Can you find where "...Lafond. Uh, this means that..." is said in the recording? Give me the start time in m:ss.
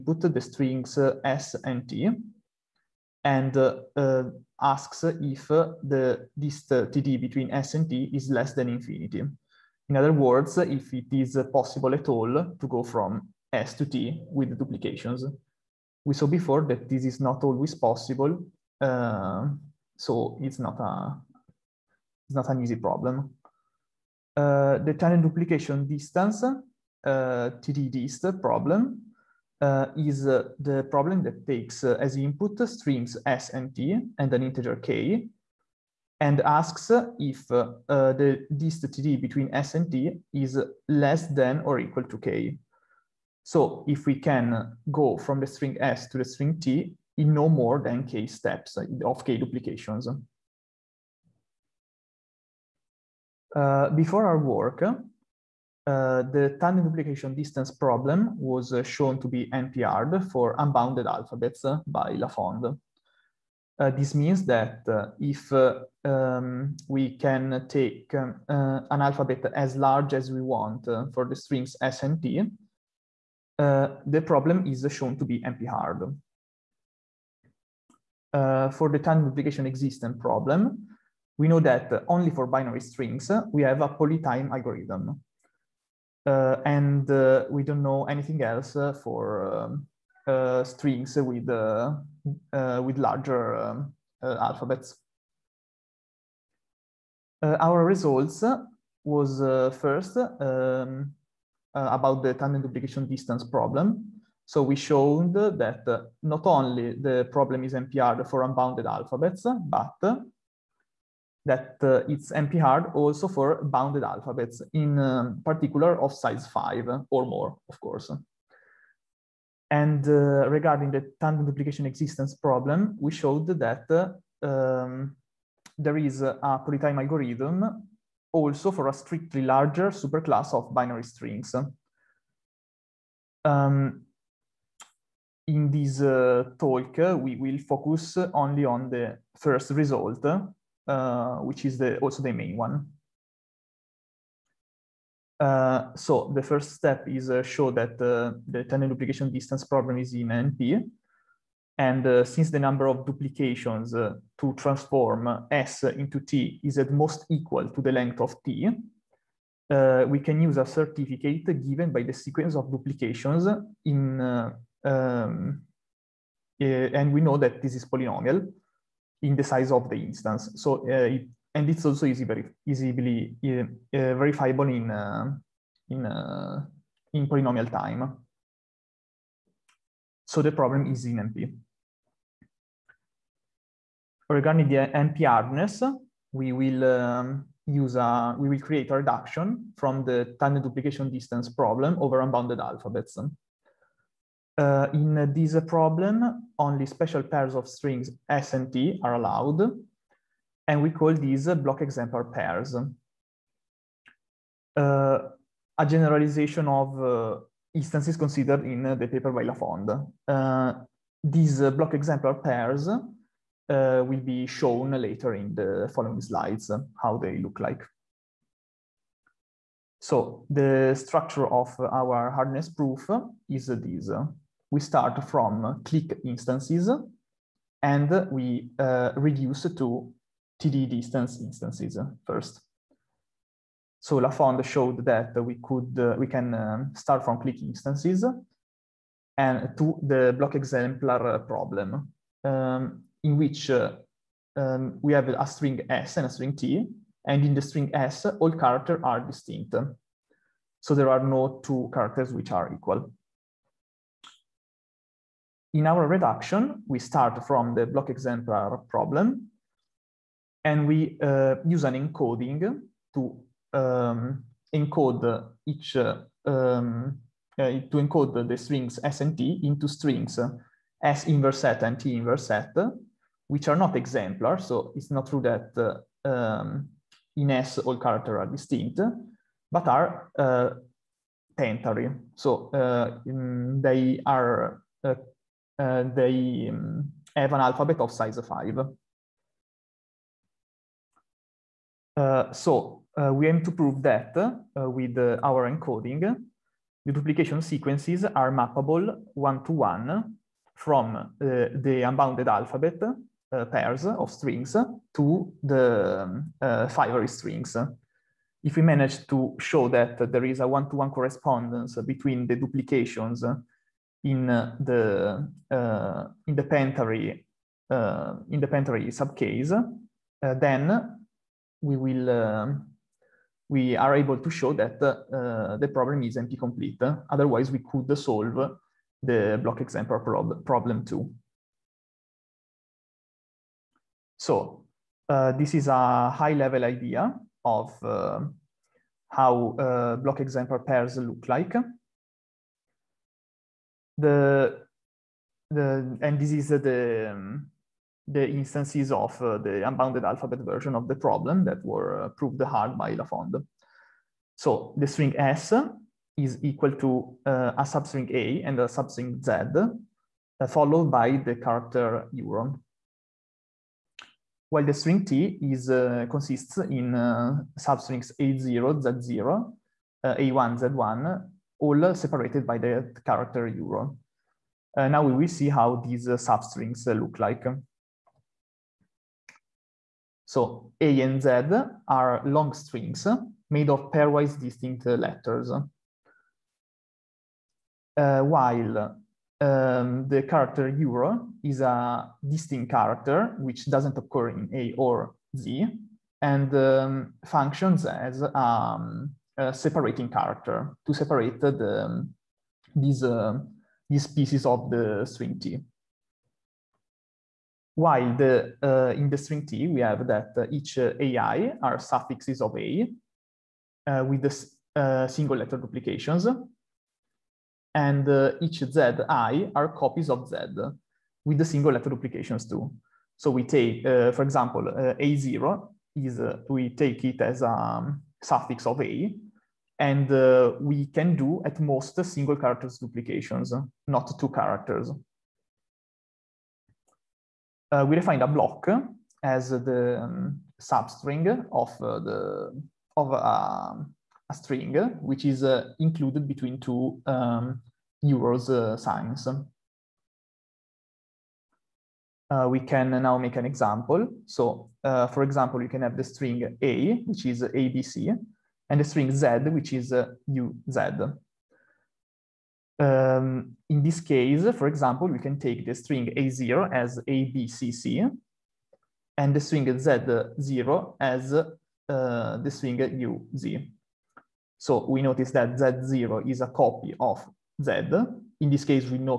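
1:02.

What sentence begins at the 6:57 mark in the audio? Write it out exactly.
And uh, each ZI are copies of Z with the single letter duplications too.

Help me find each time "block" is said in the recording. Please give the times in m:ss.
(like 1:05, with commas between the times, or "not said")
3:21, 3:31, 4:00, 4:17, 5:29, 5:40, 7:18.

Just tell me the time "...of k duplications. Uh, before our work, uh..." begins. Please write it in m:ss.
0:49.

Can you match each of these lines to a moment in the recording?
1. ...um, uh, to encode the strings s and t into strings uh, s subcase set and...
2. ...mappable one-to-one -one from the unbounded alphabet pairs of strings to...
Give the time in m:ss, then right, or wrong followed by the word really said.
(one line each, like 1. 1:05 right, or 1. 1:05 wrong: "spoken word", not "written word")
1. 4:26 wrong: "inverse", not "subcase"
2. 4:58 right.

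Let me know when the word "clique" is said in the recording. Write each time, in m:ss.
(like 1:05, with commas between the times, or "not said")
3:45, 3:57.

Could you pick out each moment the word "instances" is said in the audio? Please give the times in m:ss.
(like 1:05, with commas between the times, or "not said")
2:49, 3:27, 3:46, 3:51, 3:57, 5:48.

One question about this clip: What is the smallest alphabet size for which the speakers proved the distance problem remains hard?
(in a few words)
5.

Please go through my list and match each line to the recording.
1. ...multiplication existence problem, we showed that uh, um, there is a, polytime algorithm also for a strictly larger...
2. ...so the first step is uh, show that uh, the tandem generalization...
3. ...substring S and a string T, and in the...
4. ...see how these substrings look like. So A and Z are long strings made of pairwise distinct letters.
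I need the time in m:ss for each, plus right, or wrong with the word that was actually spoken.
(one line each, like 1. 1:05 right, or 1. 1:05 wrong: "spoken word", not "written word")
1. 2:01 wrong: "duplication", not "multiplication"
2. 2:25 wrong: "duplication", not "generalization"
3. 4:05 wrong: "string", not "substring"
4. 6:15 right.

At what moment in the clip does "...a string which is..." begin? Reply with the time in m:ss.
7:23.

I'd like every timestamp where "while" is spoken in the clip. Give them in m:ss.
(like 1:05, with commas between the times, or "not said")
6:04, 6:28, 6:47.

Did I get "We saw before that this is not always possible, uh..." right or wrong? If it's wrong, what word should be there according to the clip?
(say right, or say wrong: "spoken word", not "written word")
right.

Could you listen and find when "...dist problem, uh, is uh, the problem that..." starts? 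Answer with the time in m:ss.
0:27.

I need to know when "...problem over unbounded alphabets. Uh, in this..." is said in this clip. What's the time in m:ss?
3:11.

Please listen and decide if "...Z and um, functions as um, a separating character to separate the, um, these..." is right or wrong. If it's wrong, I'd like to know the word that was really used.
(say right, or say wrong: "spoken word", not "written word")
right.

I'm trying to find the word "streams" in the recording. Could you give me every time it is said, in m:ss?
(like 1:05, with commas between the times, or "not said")
0:32.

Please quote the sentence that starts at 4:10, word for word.
So there are no two characters which are equal.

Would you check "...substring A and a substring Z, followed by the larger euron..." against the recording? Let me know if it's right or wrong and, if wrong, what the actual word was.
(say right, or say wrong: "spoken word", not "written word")
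wrong: "character", not "larger".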